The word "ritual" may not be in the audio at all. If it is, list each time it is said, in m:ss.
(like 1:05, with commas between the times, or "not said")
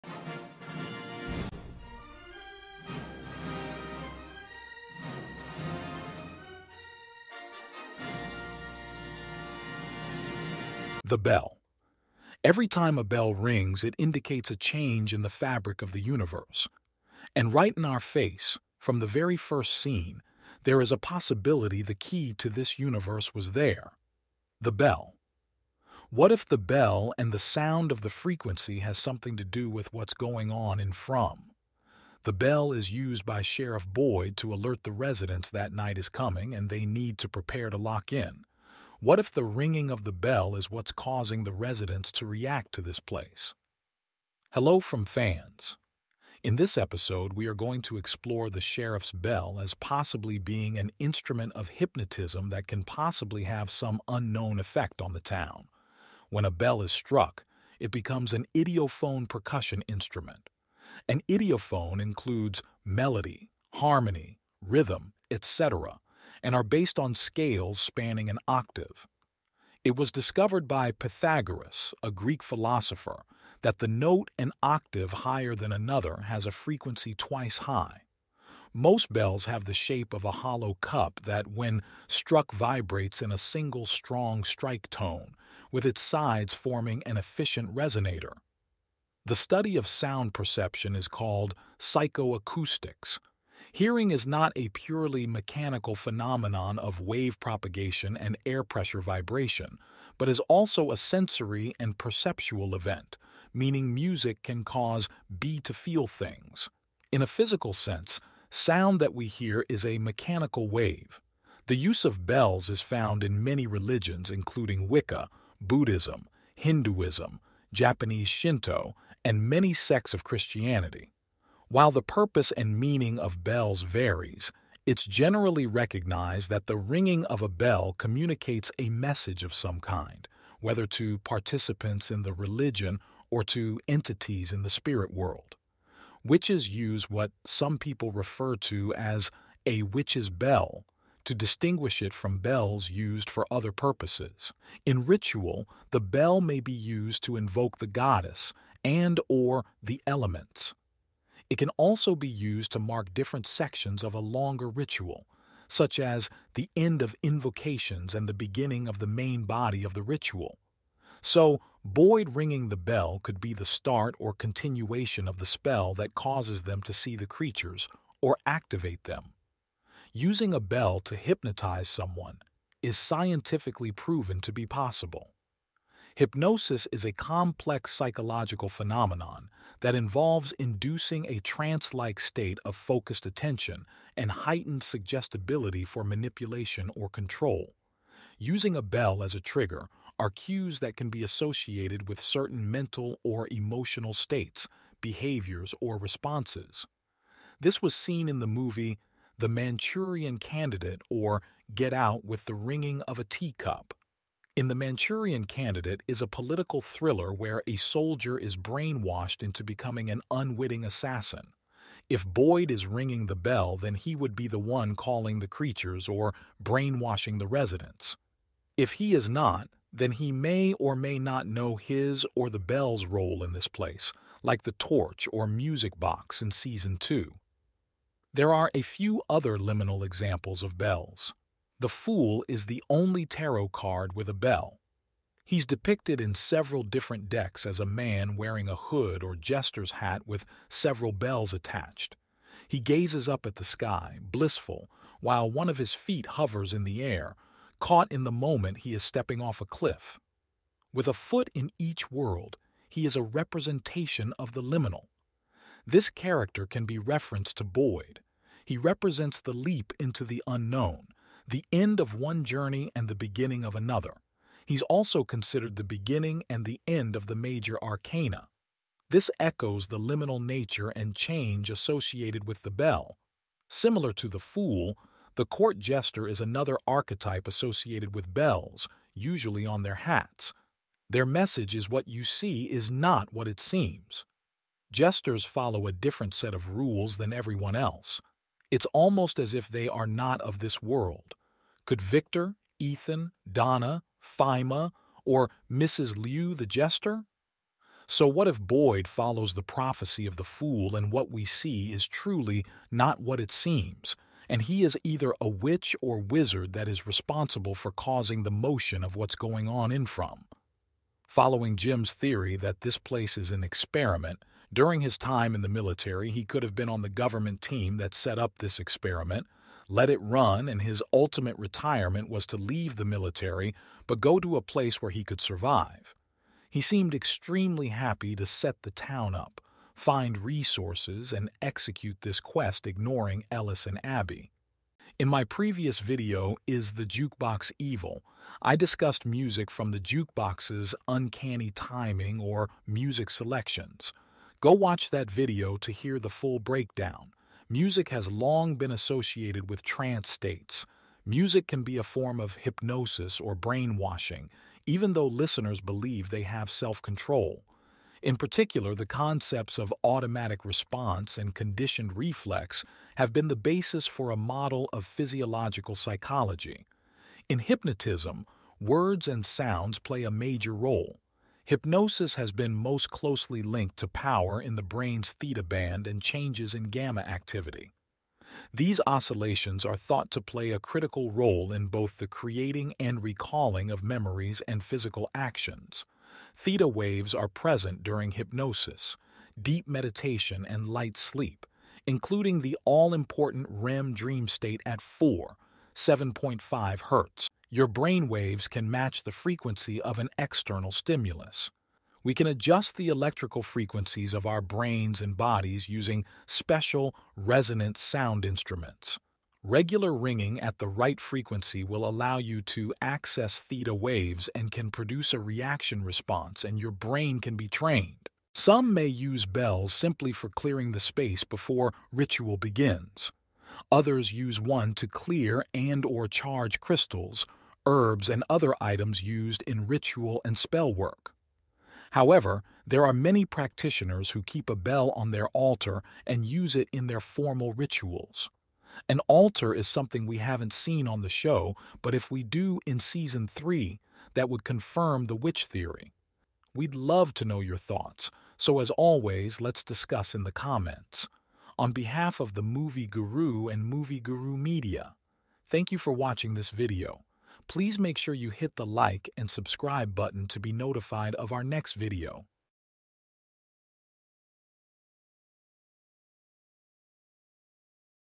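2:25, 2:34, 2:40, 7:02, 7:09, 7:17.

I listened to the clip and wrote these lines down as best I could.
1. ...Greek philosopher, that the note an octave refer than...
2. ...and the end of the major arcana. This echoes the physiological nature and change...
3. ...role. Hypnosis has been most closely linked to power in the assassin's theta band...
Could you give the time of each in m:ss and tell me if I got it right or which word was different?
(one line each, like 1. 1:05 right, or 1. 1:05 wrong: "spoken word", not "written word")
1. 1:12 wrong: "higher", not "refer"
2. 4:26 wrong: "liminal", not "physiological"
3. 6:10 wrong: "brain", not "assassin".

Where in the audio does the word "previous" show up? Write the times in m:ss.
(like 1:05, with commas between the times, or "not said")
5:35.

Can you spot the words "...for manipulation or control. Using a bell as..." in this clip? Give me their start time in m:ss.
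3:05.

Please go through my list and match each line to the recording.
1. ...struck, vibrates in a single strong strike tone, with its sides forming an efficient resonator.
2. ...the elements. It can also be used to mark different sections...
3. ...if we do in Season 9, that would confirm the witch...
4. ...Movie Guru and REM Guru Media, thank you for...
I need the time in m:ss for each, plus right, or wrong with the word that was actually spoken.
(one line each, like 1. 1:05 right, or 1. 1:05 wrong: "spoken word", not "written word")
1. 1:22 right
2. 2:29 right
3. 7:22 wrong: "3", not "9"
4. 7:32 wrong: "Movie", not "REM".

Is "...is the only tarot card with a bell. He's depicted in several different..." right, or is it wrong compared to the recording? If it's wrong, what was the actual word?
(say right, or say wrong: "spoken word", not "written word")
right.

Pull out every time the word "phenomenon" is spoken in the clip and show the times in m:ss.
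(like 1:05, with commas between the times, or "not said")
1:35, 2:58.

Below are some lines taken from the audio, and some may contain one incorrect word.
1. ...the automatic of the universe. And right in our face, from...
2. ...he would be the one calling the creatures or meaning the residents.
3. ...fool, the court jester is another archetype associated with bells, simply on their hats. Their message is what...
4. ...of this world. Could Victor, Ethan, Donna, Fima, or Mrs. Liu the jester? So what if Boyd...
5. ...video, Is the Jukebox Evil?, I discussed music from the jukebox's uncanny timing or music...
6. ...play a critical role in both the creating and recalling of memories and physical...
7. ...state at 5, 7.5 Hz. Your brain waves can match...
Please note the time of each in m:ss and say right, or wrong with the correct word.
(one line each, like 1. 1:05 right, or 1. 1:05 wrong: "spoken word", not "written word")
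1. 0:15 wrong: "fabric", not "automatic"
2. 3:33 wrong: "brainwashing", not "meaning"
3. 4:34 wrong: "usually", not "simply"
4. 4:50 right
5. 5:35 right
6. 6:20 right
7. 6:34 wrong: "4", not "5".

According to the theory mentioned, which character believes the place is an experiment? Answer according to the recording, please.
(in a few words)
Jim.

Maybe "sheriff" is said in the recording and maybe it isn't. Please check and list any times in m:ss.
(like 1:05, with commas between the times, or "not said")
0:33, 0:48.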